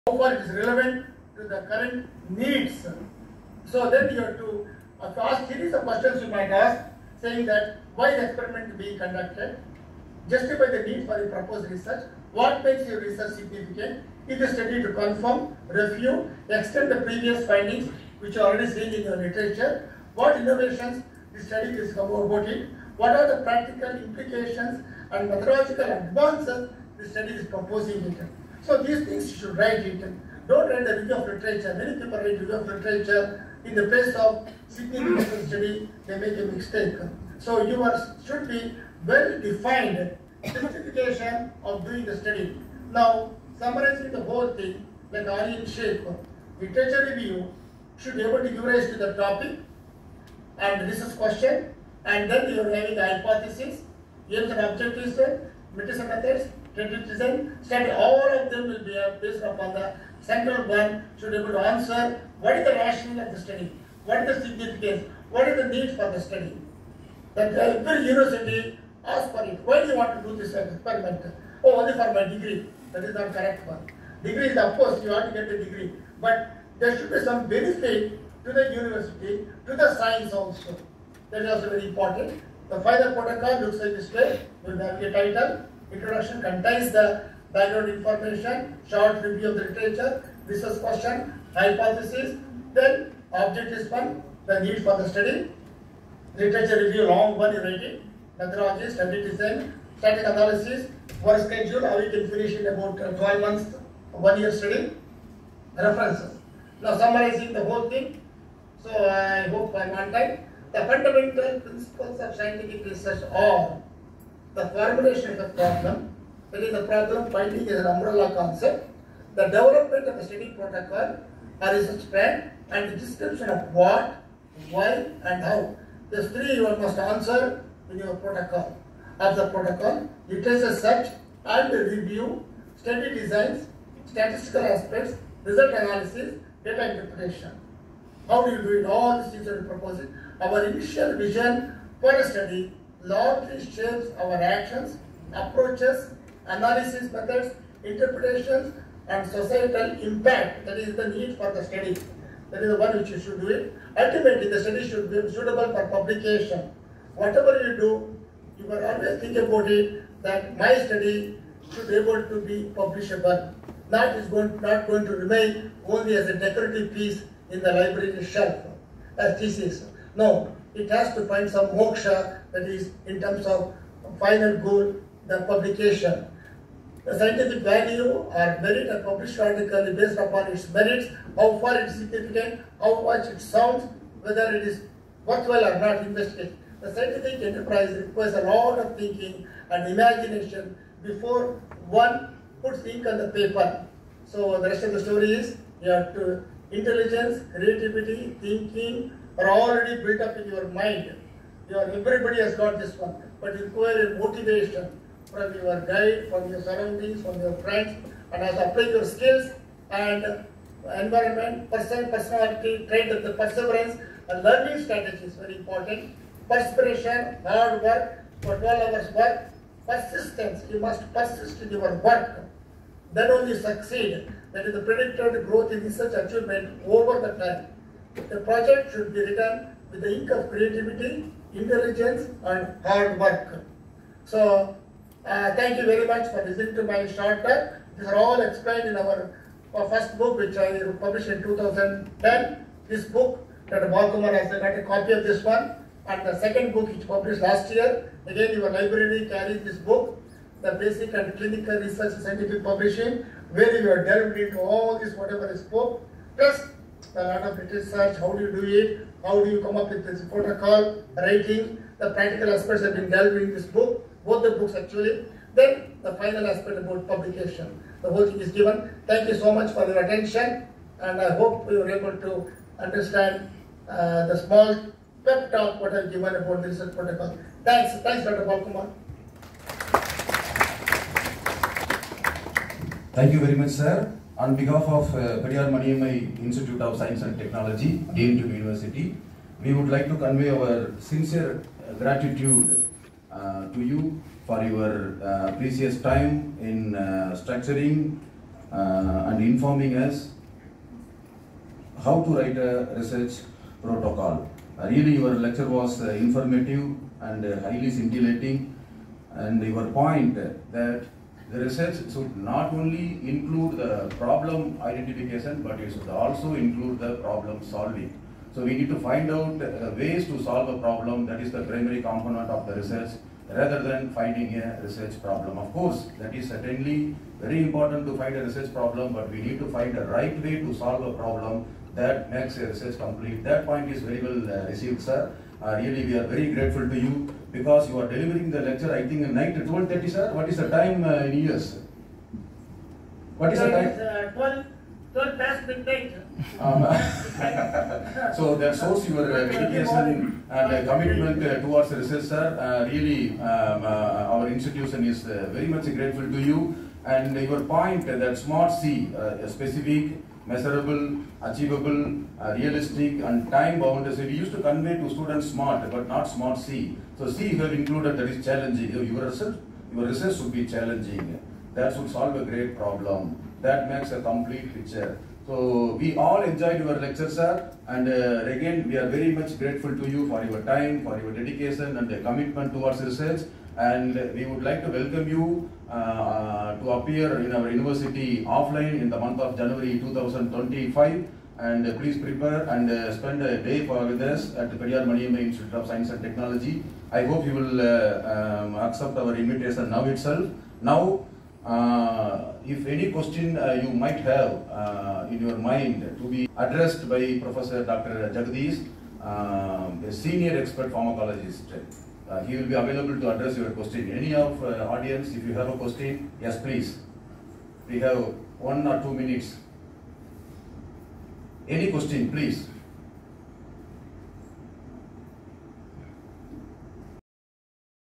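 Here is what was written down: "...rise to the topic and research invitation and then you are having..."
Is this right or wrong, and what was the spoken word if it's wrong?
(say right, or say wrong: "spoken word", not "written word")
wrong: "question", not "invitation".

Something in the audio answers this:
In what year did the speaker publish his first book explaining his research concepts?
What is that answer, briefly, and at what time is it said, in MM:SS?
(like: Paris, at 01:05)
2010, at 04:01.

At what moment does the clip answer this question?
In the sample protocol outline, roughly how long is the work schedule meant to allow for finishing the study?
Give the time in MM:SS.
01:43.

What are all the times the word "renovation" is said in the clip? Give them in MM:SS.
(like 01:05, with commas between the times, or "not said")
not said.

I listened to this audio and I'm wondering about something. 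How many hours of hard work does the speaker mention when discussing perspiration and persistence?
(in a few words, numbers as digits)
12.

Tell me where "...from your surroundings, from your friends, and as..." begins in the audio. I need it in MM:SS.
03:26.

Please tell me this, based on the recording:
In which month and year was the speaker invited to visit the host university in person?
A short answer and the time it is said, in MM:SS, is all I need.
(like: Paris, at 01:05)
January 2025, at 06:29.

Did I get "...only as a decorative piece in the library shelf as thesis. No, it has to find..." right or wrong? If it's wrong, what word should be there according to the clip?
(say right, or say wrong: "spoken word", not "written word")
right.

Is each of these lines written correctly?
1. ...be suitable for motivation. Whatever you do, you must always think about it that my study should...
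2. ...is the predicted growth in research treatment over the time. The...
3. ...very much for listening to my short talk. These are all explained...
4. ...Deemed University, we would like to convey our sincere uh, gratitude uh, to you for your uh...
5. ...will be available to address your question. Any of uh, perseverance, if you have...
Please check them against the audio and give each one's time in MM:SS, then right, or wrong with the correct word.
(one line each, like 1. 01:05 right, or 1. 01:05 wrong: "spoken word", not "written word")
1. 02:35 wrong: "publication", not "motivation"
2. 03:44 wrong: "achievement", not "treatment"
3. 03:55 right
4. 04:48 right
5. 06:52 wrong: "audience", not "perseverance".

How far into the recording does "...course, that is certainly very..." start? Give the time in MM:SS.
05:25.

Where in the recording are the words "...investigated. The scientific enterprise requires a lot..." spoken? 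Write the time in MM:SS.
03:06.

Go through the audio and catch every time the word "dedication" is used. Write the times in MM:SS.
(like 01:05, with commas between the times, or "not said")
05:49, 06:21.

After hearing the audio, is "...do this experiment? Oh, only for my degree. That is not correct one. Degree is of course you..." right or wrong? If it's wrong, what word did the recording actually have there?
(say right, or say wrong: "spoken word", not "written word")
right.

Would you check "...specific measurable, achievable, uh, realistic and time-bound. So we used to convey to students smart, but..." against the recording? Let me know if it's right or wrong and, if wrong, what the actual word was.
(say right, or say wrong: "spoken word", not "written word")
right.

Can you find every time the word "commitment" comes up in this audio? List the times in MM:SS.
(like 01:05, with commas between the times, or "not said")
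05:50, 06:22.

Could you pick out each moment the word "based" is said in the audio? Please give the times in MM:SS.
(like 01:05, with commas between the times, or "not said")
00:59, 02:59.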